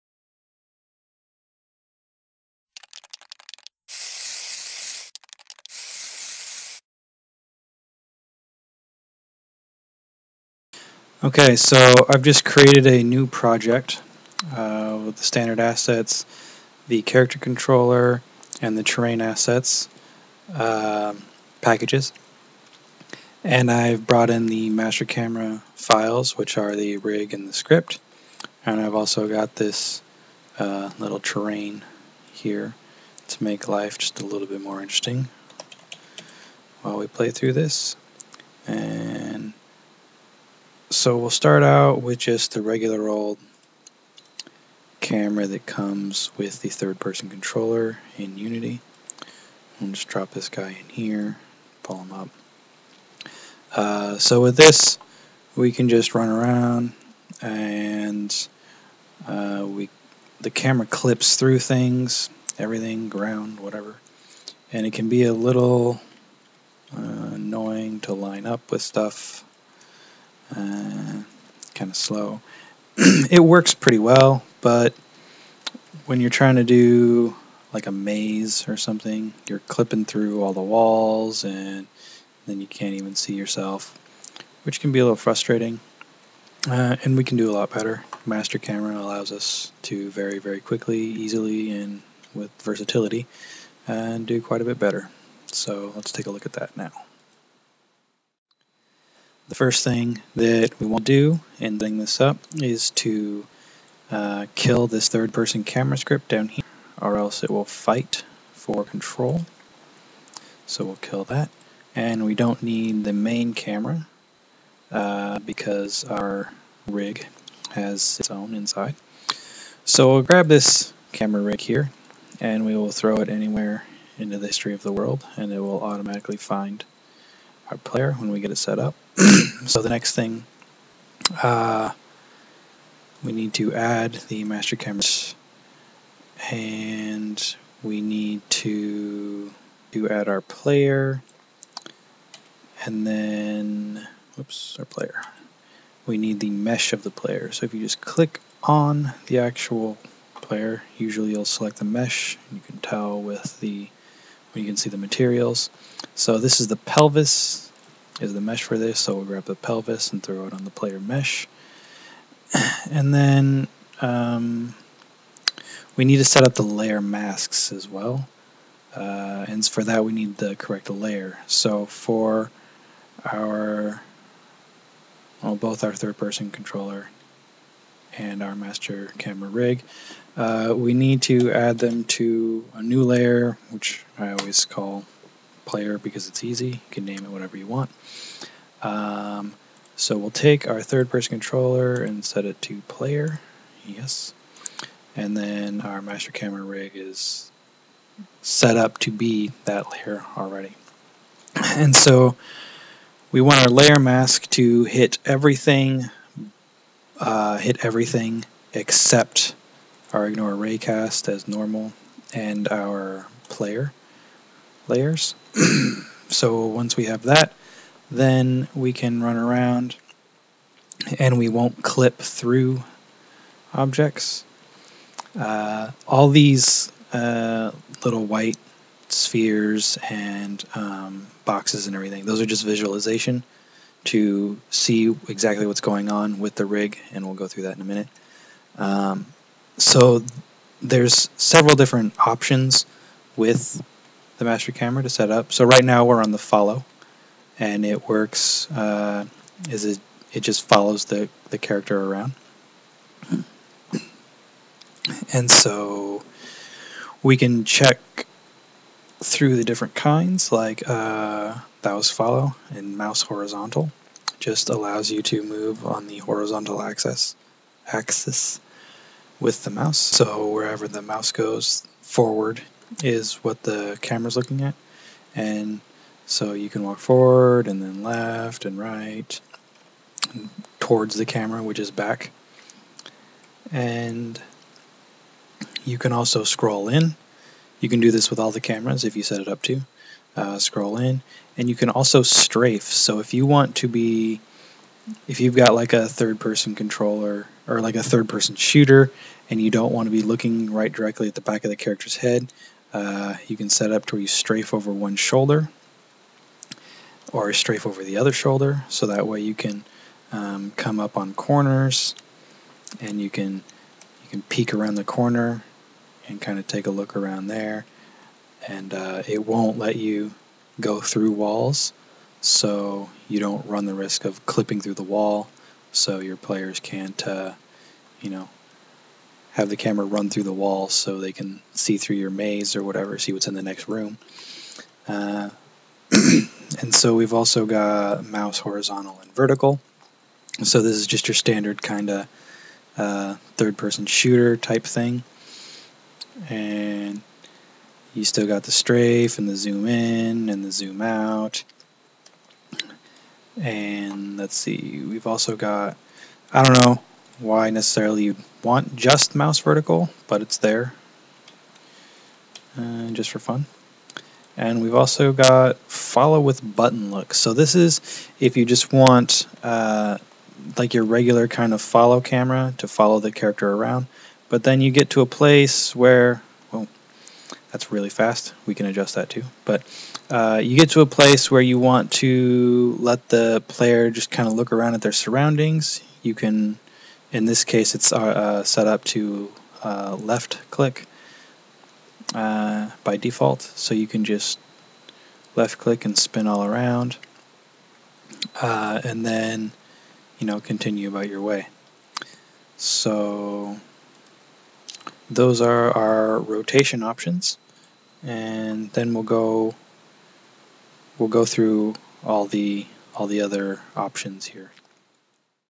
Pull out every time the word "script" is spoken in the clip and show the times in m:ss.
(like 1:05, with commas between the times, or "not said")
0:27, 1:45.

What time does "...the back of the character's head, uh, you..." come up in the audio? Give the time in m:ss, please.
5:01.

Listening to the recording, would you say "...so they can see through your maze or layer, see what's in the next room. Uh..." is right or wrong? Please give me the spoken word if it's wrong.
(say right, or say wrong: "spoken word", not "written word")
wrong: "whatever", not "layer".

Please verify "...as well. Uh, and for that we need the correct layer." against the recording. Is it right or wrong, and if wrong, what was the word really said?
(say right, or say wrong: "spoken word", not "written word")
right.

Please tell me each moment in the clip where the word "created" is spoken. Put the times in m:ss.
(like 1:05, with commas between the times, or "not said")
0:12.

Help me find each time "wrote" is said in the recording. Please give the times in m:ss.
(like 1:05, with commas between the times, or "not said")
not said.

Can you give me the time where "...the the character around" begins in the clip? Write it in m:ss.
4:11.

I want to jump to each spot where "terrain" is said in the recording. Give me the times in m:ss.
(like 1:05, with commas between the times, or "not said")
0:18, 0:31.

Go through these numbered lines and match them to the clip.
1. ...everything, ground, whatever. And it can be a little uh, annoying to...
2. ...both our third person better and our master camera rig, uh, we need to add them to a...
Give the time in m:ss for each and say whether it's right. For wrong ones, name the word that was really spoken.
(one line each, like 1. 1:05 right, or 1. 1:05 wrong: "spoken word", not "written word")
1. 1:02 right
2. 2:55 wrong: "controller", not "better".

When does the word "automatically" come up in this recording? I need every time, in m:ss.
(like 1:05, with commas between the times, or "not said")
2:05.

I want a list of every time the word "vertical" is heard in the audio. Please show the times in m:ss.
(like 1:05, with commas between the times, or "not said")
5:39, 5:59.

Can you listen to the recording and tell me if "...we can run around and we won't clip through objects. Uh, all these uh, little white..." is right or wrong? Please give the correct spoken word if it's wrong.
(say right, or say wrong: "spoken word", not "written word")
right.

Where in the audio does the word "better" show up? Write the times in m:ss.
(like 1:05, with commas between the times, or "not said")
1:27, 1:34.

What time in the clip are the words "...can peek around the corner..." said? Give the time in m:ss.
5:14.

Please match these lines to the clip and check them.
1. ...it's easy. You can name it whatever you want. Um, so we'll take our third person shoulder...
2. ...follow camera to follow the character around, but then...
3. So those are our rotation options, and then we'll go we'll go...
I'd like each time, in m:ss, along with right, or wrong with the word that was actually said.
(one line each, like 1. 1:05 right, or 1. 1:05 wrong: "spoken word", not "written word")
1. 3:06 wrong: "controller", not "shoulder"
2. 6:11 right
3. 6:42 right.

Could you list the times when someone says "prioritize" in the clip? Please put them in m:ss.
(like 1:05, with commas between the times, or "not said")
not said.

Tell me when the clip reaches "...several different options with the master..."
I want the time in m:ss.
4:01.